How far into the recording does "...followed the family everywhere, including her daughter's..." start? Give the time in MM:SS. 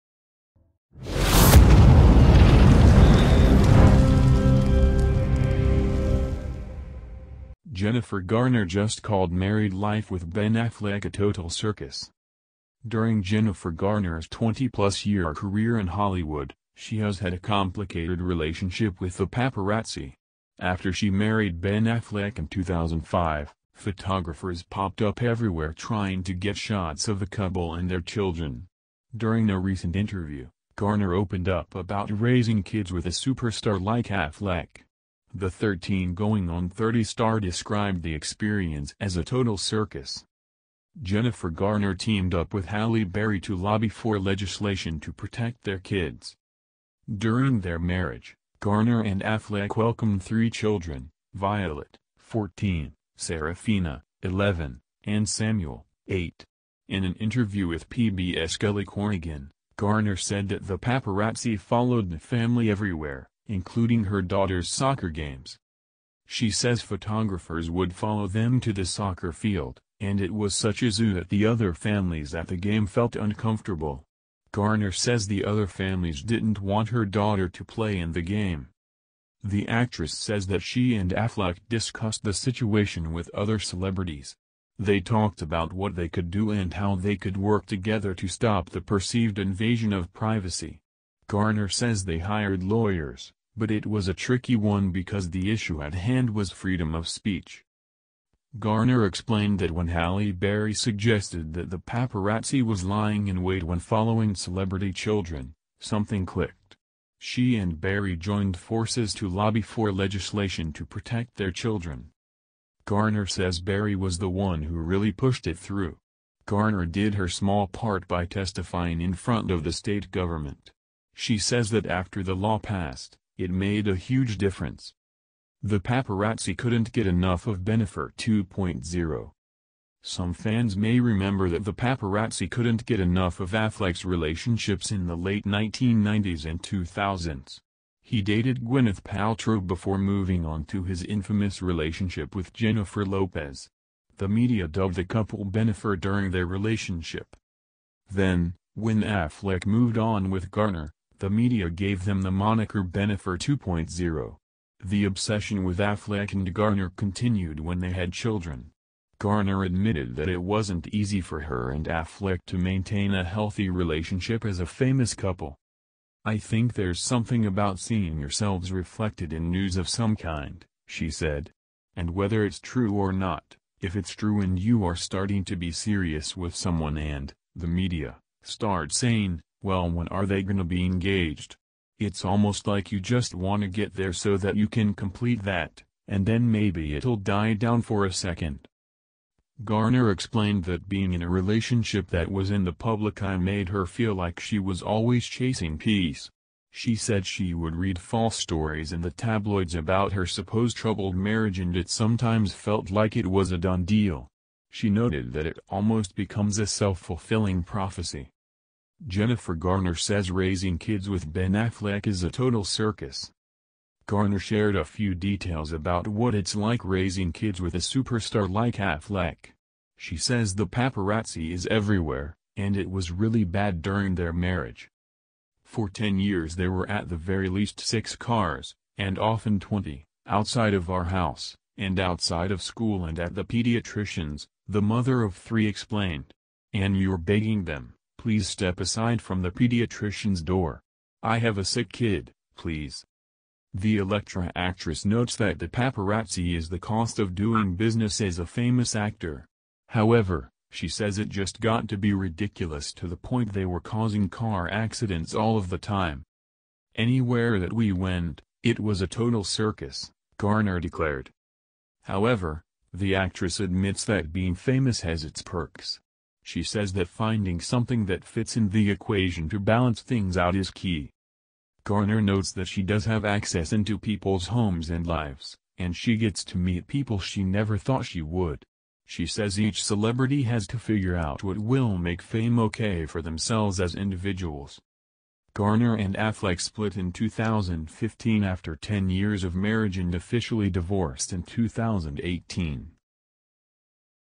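01:01.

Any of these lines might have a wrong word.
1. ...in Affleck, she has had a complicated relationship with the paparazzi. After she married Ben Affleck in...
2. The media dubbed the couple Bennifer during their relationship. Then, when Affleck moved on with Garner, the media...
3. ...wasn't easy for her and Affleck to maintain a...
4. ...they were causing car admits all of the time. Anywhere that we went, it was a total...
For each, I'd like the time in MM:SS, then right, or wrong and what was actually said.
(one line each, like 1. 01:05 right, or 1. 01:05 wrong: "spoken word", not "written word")
1. 00:15 wrong: "Hollywood", not "Affleck"
2. 02:24 right
3. 02:40 right
4. 04:13 wrong: "accidents", not "admits".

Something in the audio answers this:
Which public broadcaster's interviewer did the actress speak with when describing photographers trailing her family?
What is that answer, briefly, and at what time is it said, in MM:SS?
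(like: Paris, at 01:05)
PBS, at 00:57.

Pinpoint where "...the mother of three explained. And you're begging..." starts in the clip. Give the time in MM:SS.
03:54.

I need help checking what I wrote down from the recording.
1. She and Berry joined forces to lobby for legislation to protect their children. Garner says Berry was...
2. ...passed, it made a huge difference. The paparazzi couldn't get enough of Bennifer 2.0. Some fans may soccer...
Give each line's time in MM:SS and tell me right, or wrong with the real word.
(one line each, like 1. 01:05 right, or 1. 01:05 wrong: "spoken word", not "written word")
1. 01:47 right
2. 02:02 wrong: "remember", not "soccer".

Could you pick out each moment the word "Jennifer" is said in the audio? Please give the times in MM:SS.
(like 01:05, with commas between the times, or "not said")
00:07, 00:13, 00:41, 02:22, 03:29.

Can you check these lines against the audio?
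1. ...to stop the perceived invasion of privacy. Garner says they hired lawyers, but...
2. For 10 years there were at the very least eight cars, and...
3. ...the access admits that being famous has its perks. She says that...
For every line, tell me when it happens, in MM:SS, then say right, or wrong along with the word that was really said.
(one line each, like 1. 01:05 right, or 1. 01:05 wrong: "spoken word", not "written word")
1. 01:28 right
2. 03:45 wrong: "six", not "eight"
3. 04:22 wrong: "actress", not "access".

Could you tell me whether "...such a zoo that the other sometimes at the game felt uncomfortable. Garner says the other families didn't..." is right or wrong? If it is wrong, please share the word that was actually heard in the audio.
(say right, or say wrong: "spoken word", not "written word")
wrong: "families", not "sometimes".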